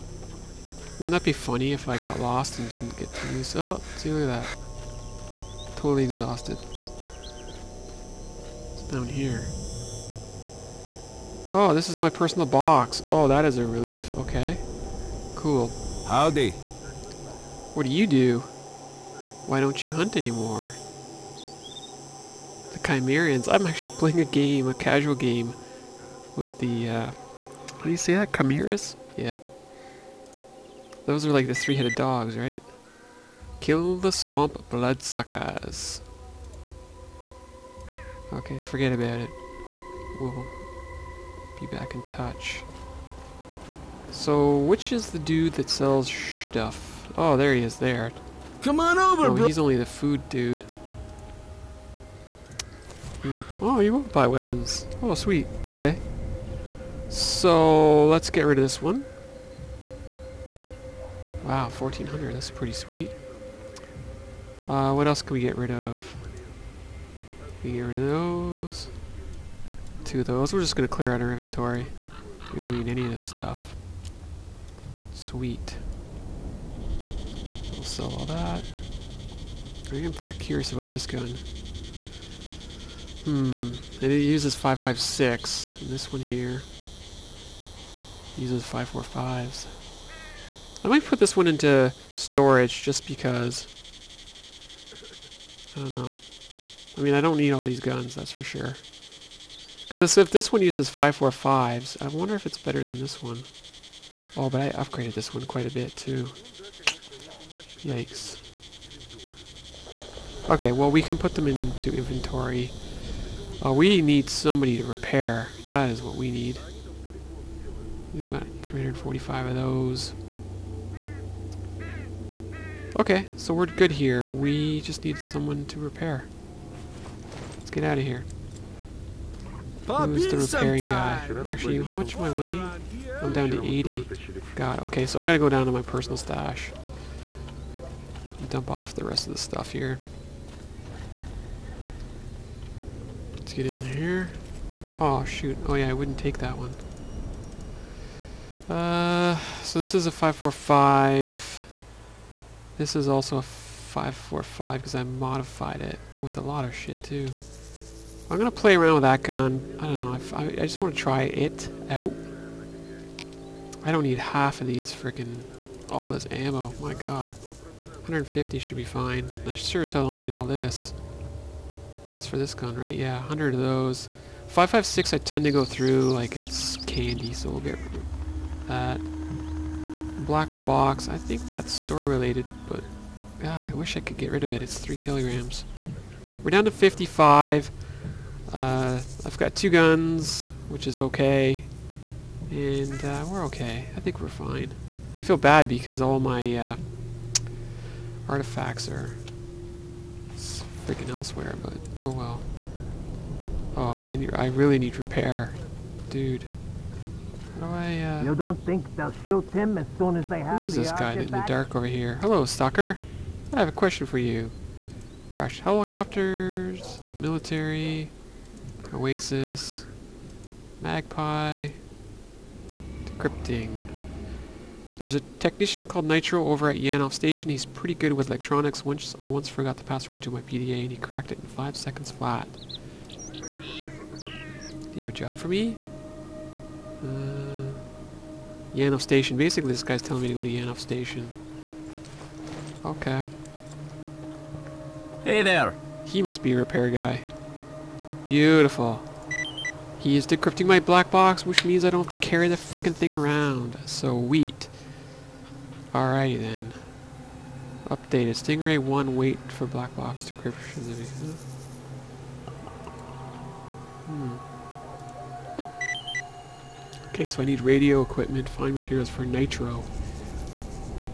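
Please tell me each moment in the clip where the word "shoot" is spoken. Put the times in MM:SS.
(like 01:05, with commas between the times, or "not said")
02:25, 03:29.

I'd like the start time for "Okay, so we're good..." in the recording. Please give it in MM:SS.
02:02.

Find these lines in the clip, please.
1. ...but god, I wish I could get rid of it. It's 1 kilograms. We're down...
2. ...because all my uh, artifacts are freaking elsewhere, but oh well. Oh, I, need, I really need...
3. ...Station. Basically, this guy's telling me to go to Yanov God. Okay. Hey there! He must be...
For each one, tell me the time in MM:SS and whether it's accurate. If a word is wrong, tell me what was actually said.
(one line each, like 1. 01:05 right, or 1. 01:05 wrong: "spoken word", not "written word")
1. 03:02 wrong: "3", not "1"
2. 03:15 right
3. 03:59 wrong: "Station", not "God".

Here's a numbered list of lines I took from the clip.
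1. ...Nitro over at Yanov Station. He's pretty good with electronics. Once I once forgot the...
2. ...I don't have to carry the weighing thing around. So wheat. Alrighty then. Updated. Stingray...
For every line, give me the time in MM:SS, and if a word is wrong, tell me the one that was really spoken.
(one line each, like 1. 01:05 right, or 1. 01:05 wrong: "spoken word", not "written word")
1. 03:46 right
2. 04:11 wrong: "freaking", not "weighing".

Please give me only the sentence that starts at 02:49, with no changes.
I sure as hell don't need all this.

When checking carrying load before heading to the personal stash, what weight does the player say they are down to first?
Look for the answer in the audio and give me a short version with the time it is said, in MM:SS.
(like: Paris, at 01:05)
80, at 02:13.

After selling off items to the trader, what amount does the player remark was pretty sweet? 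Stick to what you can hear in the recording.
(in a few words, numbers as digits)
1400.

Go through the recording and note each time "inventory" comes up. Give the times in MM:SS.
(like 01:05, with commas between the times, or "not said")
01:11, 01:51.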